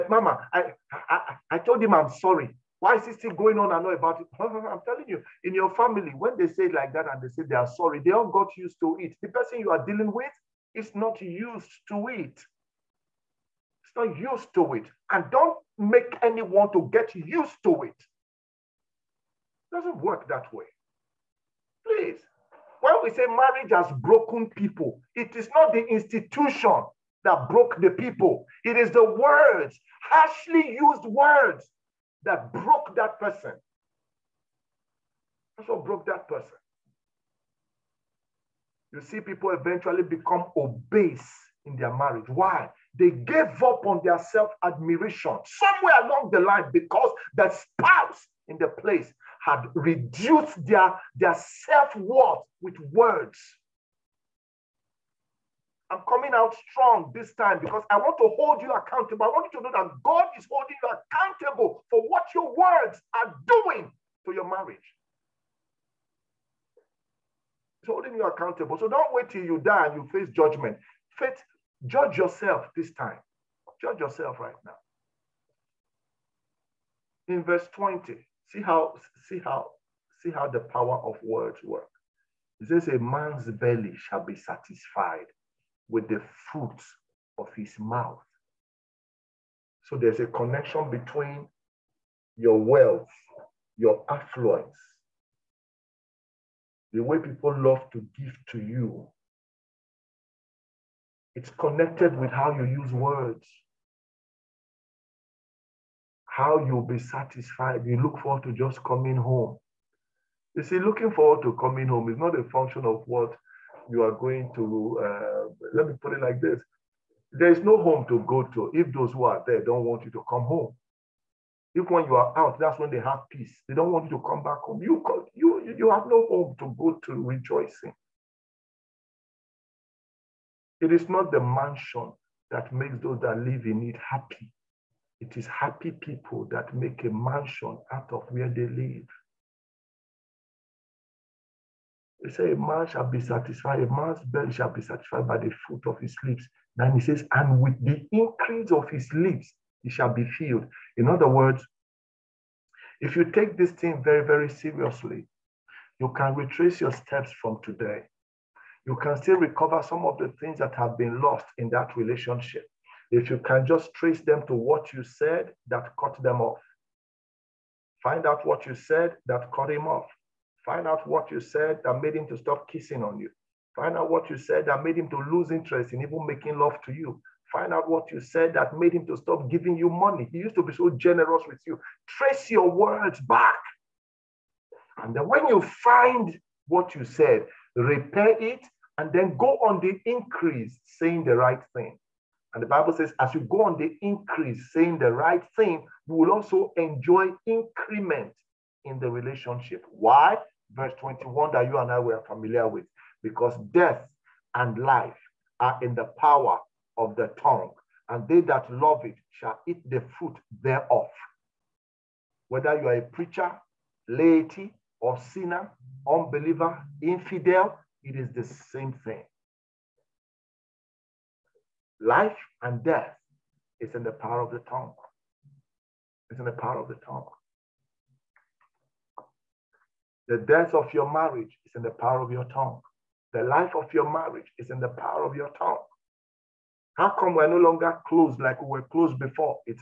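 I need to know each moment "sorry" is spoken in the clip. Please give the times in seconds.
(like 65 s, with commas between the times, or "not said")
2 s, 7 s.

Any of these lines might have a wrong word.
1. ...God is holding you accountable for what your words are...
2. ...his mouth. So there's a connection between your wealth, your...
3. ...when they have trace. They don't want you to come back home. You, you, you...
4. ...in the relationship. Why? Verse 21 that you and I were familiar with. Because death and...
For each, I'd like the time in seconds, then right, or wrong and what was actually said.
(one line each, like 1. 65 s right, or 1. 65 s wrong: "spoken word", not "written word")
1. 60 s right
2. 87 s right
3. 122 s wrong: "peace", not "trace"
4. 198 s right.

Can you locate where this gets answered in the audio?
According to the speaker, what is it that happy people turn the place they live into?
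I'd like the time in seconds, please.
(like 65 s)
137 s.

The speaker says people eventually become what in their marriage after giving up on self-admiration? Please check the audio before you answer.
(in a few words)
obese.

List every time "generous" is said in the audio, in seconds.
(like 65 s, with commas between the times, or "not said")
180 s.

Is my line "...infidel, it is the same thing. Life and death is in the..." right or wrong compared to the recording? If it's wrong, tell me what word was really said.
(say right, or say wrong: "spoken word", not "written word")
right.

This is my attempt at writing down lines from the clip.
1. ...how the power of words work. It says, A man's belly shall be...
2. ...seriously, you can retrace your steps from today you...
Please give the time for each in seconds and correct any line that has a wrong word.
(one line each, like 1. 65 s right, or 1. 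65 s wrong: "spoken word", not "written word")
1. 80 s right
2. 154 s right.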